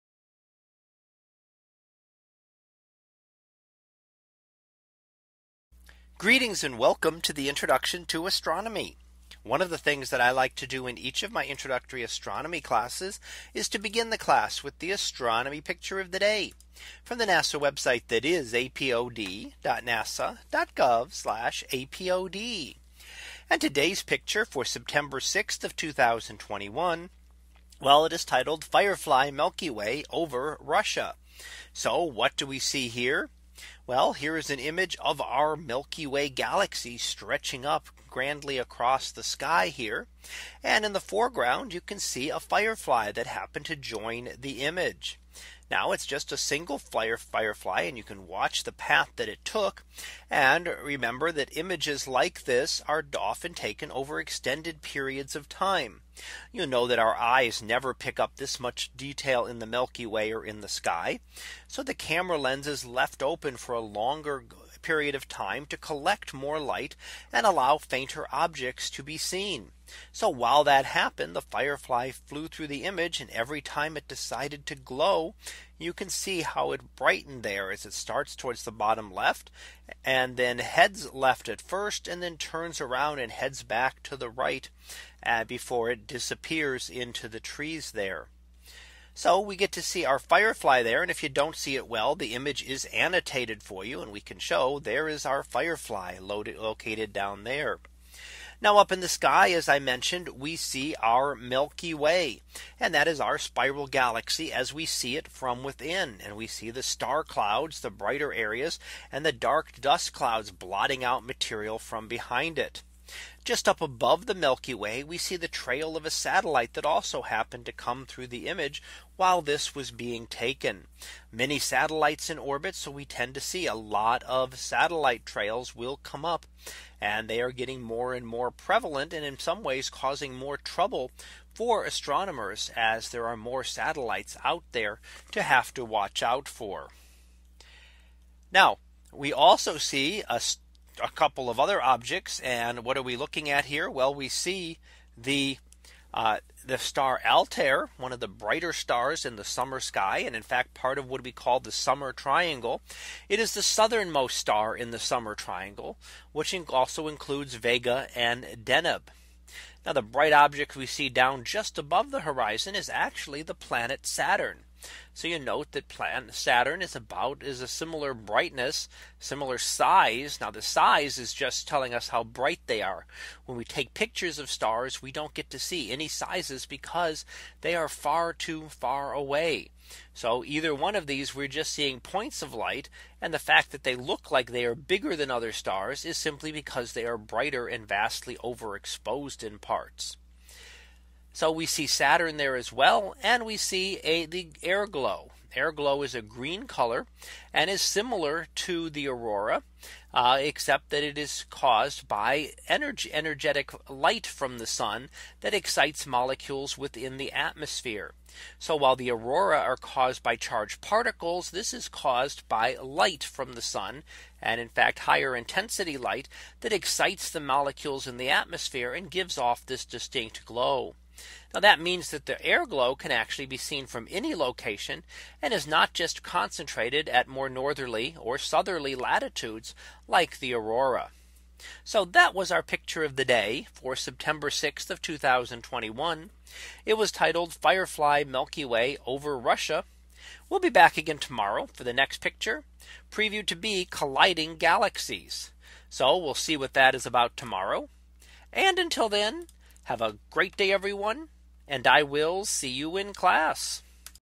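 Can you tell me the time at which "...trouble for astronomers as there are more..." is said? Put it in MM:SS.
02:10.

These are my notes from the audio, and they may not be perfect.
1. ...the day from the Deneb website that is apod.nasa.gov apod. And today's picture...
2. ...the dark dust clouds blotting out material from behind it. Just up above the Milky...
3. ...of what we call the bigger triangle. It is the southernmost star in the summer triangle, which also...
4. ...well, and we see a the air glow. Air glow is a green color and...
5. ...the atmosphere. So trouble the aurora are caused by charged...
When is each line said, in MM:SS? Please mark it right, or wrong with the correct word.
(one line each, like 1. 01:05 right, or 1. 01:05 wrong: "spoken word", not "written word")
1. 00:16 wrong: "NASA", not "Deneb"
2. 01:49 right
3. 02:30 wrong: "summer", not "bigger"
4. 03:12 right
5. 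03:27 wrong: "while", not "trouble".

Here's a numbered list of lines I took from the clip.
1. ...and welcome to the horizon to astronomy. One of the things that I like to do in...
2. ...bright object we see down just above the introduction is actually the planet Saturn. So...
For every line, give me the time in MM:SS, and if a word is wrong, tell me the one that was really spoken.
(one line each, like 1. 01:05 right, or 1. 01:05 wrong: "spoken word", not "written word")
1. 00:06 wrong: "introduction", not "horizon"
2. 02:40 wrong: "horizon", not "introduction".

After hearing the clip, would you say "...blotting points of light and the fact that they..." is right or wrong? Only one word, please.
wrong.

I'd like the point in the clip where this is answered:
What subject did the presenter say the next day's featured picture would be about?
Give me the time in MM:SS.
04:03.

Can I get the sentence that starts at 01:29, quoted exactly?
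So we get to see our firefly there.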